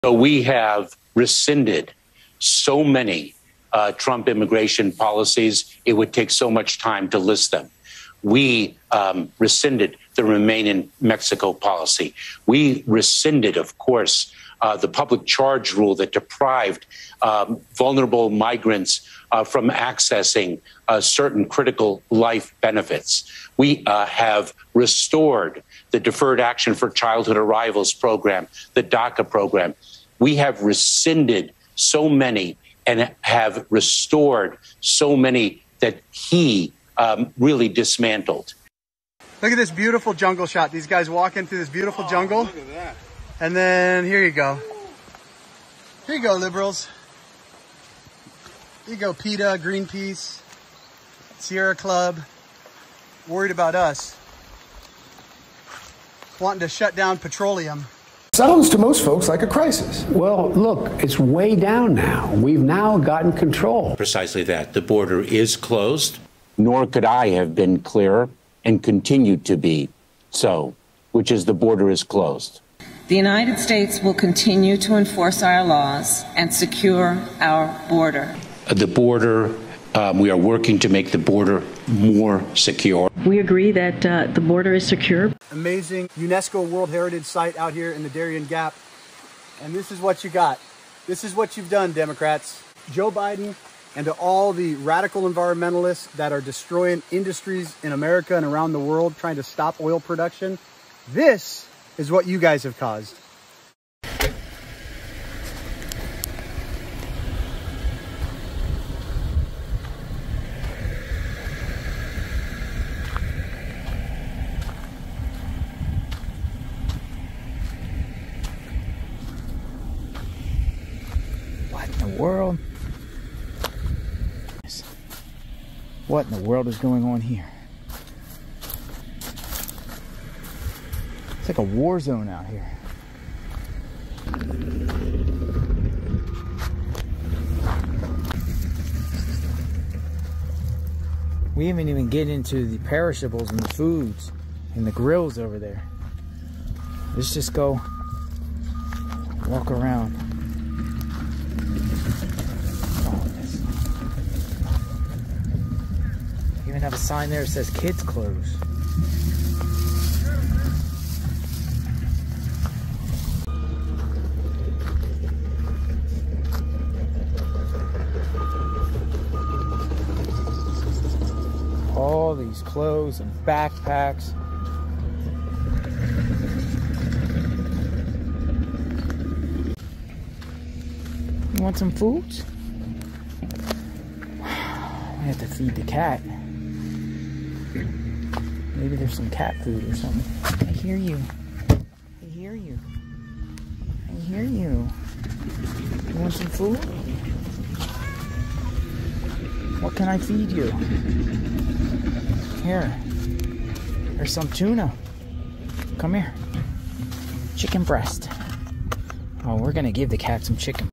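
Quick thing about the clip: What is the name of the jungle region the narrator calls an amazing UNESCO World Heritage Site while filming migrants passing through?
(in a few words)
Darien Gap.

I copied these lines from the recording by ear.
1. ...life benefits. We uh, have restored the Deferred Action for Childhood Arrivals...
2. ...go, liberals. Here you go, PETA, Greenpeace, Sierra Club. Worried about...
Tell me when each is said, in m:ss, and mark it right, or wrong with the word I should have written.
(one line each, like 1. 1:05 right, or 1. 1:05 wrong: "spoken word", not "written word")
1. 0:22 right
2. 0:46 right.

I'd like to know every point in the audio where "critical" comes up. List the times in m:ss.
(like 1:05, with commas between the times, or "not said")
0:21.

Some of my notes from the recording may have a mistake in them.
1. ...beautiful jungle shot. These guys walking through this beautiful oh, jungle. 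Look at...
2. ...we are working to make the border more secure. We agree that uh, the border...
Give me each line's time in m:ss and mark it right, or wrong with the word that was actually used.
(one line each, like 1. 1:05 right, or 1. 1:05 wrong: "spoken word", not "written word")
1. 0:39 right
2. 1:20 right.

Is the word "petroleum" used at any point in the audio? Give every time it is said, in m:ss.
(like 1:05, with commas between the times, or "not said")
0:57.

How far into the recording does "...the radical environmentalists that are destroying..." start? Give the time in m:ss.
1:34.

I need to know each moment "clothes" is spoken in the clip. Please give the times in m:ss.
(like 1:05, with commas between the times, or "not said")
2:38, 2:52.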